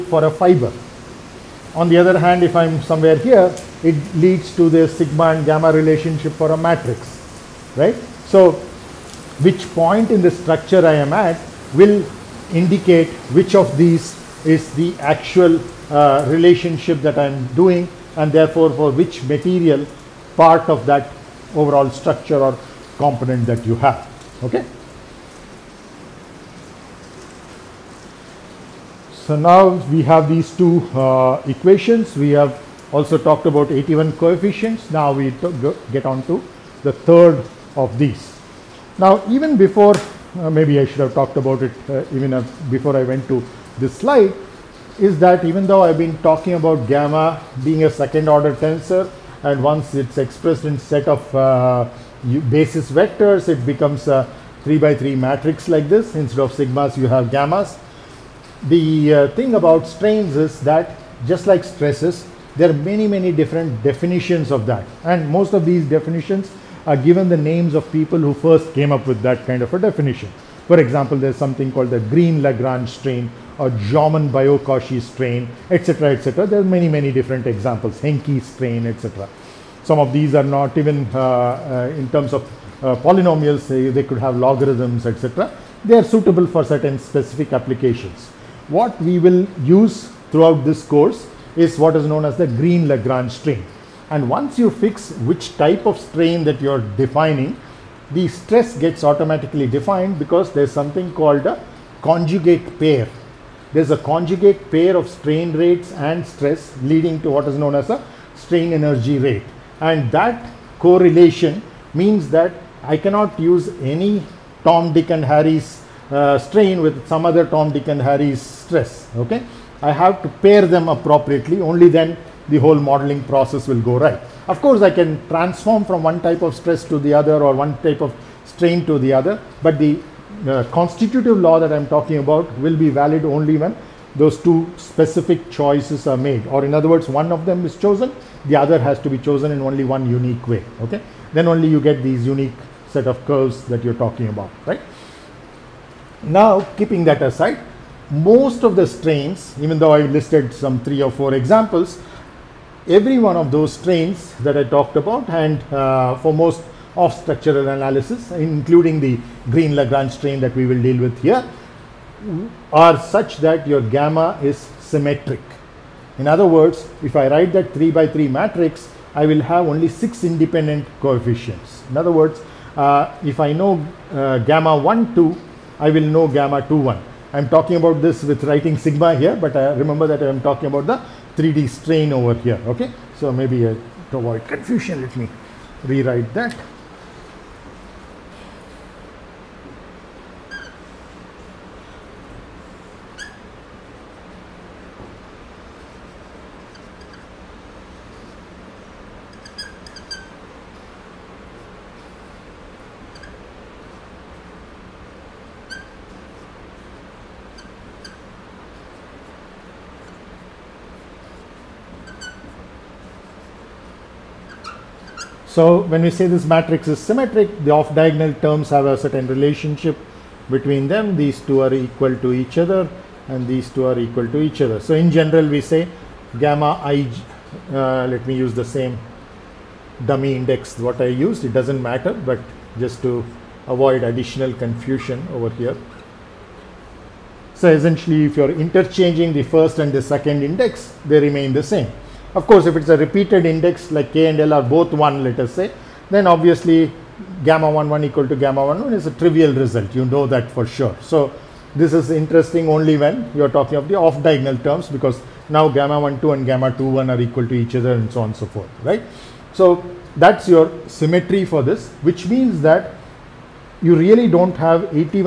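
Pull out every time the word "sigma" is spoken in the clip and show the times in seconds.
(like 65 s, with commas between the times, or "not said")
4 s, 56 s, 178 s.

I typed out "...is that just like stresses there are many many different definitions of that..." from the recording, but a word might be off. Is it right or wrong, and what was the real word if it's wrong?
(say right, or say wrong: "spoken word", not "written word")
right.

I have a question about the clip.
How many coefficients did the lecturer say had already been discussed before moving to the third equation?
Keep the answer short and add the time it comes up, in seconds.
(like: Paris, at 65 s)
81, at 33 s.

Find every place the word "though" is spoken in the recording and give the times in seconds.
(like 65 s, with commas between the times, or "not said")
45 s, 149 s.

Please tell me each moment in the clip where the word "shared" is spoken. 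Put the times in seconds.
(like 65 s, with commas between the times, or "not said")
not said.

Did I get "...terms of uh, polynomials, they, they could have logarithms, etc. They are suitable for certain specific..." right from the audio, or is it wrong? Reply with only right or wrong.
right.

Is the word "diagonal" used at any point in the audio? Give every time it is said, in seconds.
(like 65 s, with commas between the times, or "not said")
217 s, 254 s.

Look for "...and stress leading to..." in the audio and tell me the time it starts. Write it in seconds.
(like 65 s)
105 s.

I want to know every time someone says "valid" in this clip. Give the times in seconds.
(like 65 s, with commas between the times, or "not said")
132 s.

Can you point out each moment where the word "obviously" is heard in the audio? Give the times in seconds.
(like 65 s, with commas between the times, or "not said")
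246 s.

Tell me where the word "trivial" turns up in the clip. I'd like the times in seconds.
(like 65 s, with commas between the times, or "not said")
249 s.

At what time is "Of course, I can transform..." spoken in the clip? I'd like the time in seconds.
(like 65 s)
124 s.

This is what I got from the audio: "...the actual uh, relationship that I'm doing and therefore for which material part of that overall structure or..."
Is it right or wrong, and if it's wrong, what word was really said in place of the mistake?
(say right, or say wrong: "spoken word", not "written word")
right.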